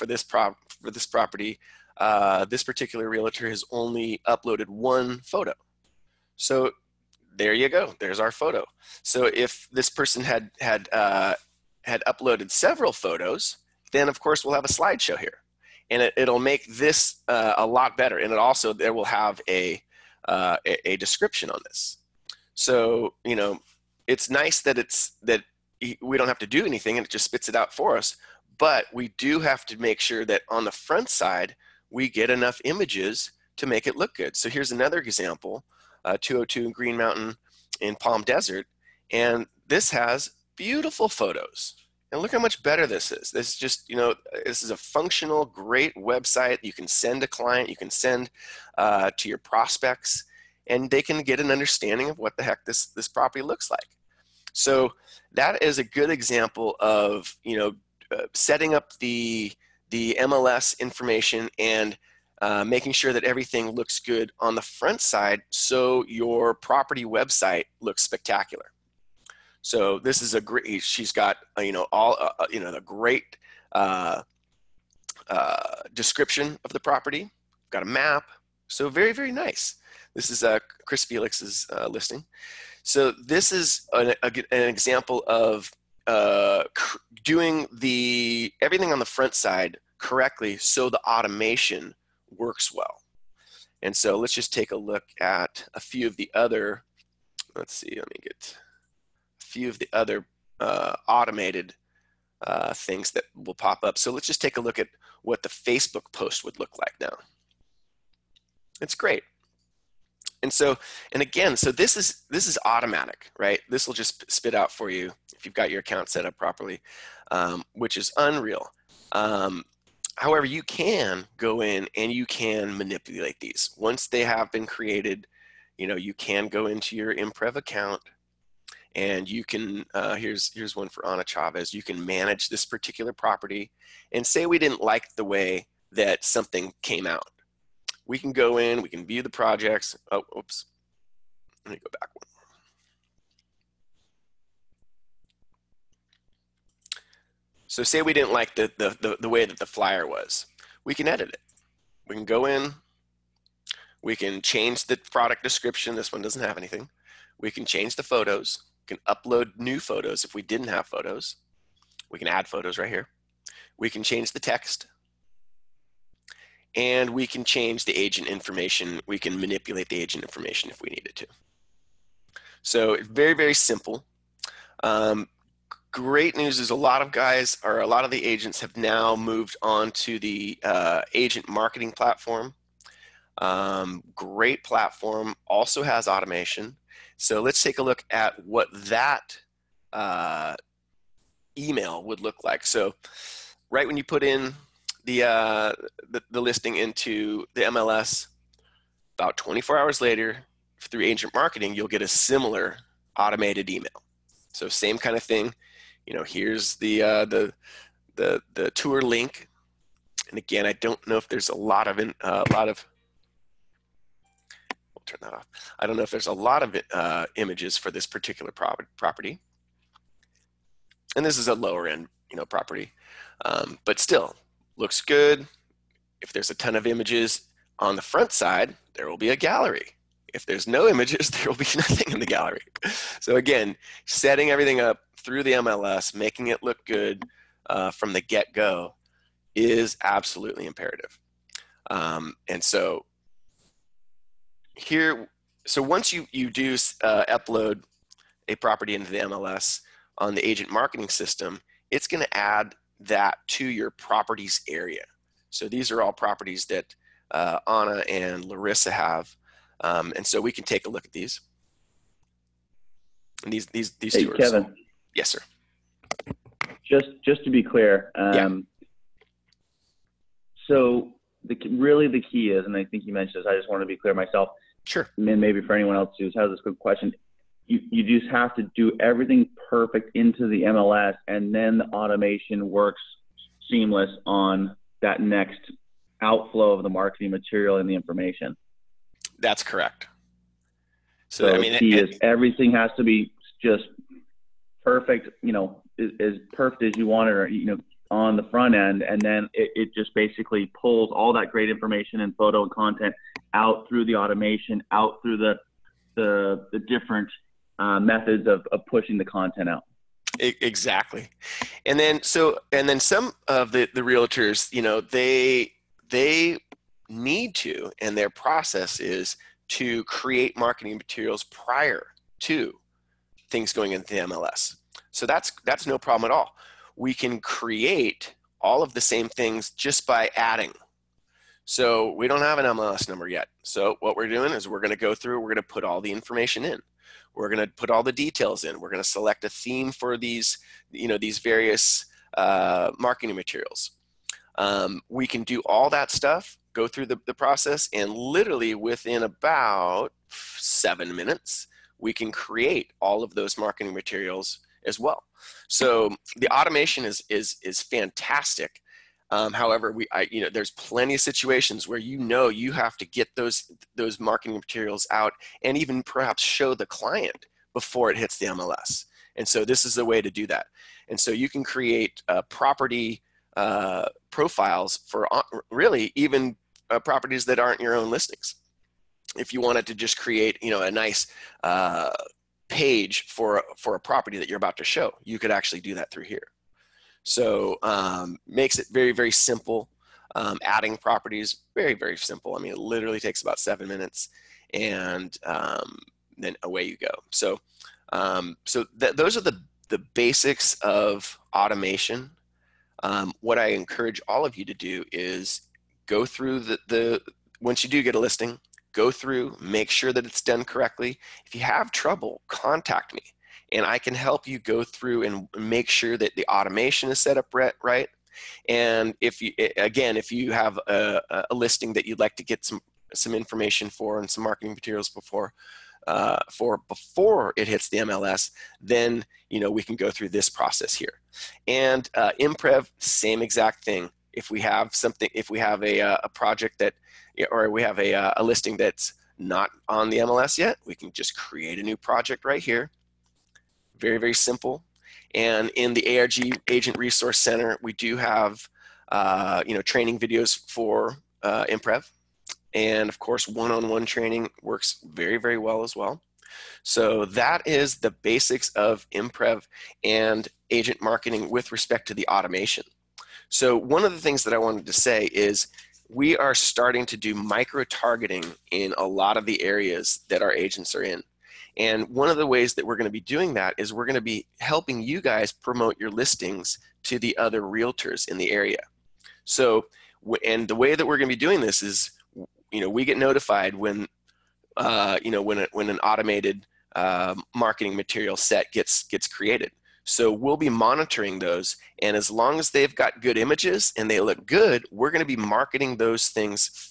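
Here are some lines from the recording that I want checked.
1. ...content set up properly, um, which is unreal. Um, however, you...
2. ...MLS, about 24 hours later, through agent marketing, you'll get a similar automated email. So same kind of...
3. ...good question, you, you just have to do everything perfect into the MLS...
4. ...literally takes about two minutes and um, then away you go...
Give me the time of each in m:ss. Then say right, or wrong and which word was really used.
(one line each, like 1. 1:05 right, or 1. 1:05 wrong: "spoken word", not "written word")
1. 1:55 wrong: "account", not "content"
2. 3:17 right
3. 4:36 right
4. 6:32 wrong: "seven", not "two".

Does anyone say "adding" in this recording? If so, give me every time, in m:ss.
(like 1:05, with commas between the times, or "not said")
5:30, 6:30.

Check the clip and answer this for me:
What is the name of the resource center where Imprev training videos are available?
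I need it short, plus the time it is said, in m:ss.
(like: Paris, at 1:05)
ARG Agent Resource Center, at 7:26.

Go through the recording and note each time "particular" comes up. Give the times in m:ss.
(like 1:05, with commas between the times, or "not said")
0:02, 2:12, 3:38.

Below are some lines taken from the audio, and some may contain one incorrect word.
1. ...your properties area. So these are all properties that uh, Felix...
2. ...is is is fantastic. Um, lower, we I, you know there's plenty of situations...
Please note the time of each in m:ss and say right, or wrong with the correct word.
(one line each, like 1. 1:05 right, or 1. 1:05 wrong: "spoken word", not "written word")
1. 4:13 wrong: "Anna", not "Felix"
2. 5:57 wrong: "however", not "lower".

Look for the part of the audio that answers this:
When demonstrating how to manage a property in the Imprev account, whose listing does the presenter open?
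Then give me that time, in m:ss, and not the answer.
2:11.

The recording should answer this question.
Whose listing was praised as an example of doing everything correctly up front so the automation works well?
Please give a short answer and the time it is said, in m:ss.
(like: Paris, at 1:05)
Chris Felix, at 1:20.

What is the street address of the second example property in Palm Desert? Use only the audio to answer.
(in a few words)
202 Green Mountain.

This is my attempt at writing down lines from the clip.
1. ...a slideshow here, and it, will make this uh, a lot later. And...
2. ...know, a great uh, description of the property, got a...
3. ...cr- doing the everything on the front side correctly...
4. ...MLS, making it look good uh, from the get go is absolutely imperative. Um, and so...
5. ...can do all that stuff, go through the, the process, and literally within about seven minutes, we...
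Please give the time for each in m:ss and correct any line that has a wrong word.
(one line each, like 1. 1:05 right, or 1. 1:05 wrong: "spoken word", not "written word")
1. 0:14 wrong: "better", not "later"
2. 1:12 right
3. 1:26 right
4. 3:55 right
5. 5:45 right.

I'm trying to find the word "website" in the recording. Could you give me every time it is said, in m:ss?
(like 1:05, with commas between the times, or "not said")
0:45, 1:07.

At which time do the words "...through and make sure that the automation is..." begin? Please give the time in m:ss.
6:54.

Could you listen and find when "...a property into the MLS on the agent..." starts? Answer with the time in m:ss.
4:08.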